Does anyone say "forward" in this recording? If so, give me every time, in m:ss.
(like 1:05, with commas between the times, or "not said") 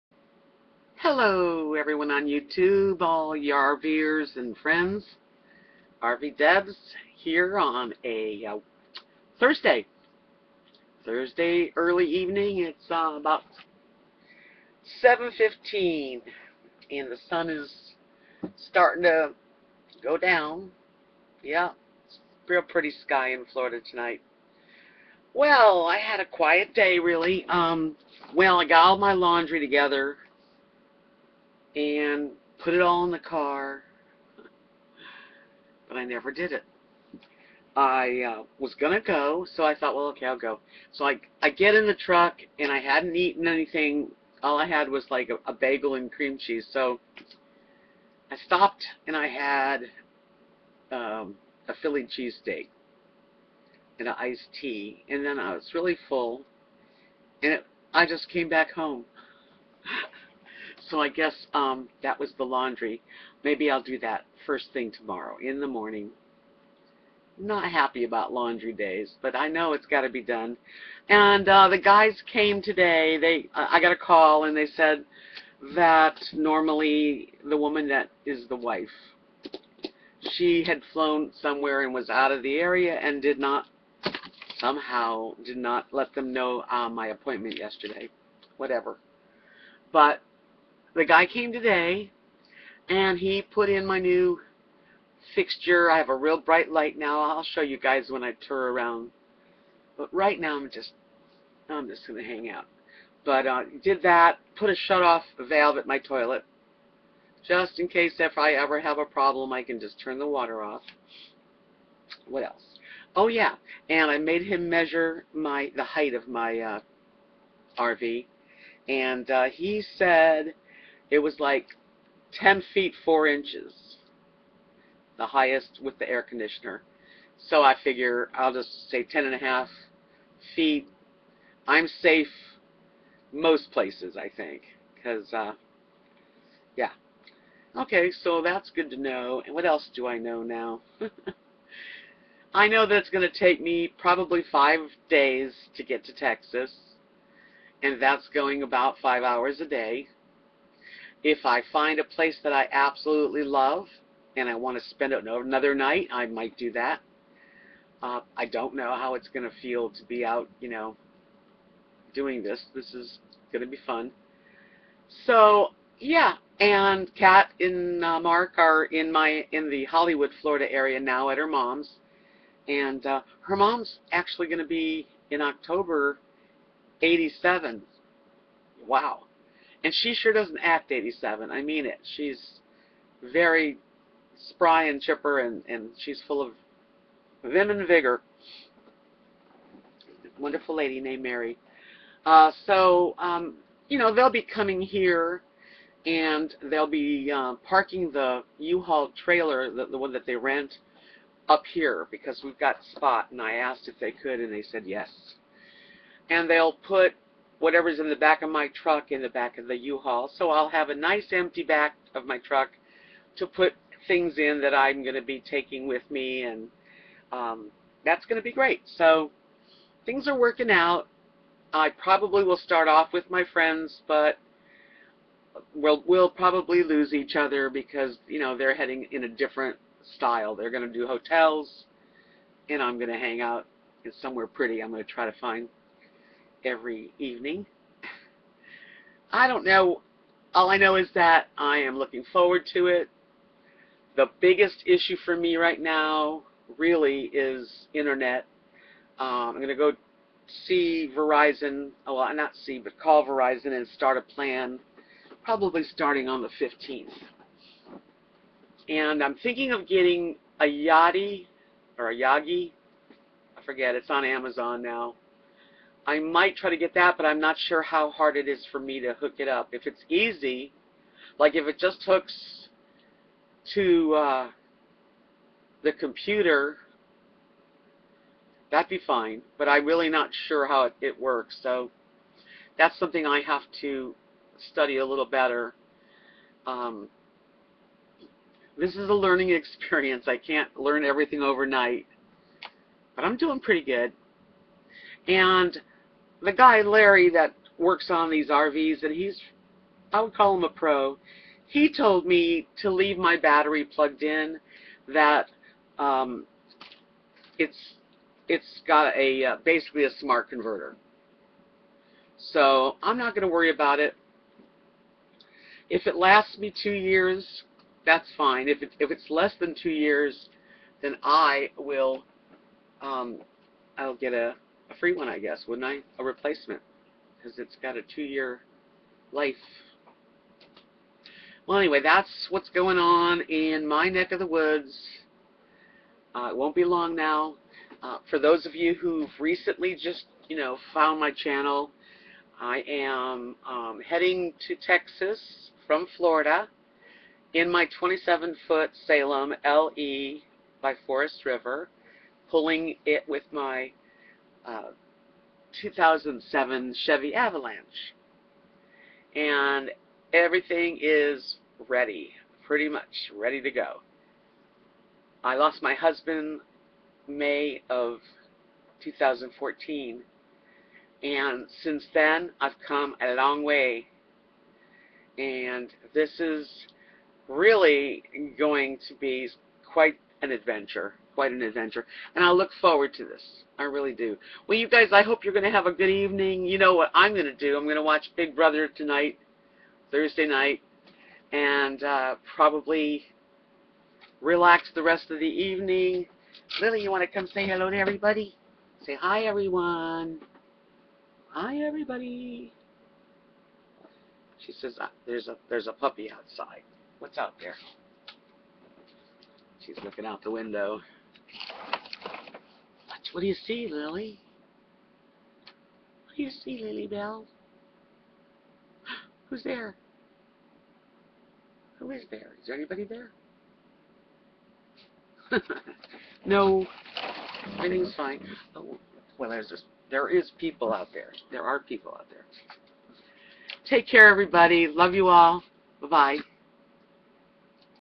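4:02, 6:22.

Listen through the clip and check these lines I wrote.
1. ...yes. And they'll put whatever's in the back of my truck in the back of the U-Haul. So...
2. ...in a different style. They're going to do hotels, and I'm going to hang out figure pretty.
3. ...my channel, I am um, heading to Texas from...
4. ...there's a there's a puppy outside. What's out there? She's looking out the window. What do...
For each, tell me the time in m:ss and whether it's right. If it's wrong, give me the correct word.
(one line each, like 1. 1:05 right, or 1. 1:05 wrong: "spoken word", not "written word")
1. 3:24 right
2. 3:49 wrong: "somewhere", not "figure"
3. 5:41 right
4. 6:45 right.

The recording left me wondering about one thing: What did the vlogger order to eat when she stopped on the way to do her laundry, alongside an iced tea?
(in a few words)
Philly cheesesteak.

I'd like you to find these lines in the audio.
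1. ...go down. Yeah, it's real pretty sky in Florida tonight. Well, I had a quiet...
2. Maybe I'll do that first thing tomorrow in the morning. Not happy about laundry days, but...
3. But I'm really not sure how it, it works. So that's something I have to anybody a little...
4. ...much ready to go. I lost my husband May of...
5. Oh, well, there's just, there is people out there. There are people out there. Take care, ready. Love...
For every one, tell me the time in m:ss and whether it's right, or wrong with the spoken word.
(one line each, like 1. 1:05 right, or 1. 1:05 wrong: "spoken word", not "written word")
1. 0:20 right
2. 1:03 right
3. 4:39 wrong: "study", not "anybody"
4. 6:02 right
5. 7:08 wrong: "everybody", not "ready".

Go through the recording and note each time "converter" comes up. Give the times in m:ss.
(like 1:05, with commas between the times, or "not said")
5:10.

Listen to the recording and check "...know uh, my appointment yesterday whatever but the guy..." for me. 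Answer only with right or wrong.
right.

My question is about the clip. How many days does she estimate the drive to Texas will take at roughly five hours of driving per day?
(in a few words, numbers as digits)
5.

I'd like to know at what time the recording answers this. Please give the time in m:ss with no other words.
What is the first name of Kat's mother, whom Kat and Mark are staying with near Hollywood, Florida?
3:11.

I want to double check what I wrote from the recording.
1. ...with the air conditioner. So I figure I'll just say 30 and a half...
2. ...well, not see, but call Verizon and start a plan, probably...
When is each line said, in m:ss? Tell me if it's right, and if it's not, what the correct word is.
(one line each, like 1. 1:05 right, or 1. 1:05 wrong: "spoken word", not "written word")
1. 2:05 wrong: "10", not "30"
2. 4:12 right.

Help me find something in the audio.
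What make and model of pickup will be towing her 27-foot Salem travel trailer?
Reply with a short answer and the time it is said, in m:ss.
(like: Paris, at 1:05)
Chevy Avalanche, at 5:57.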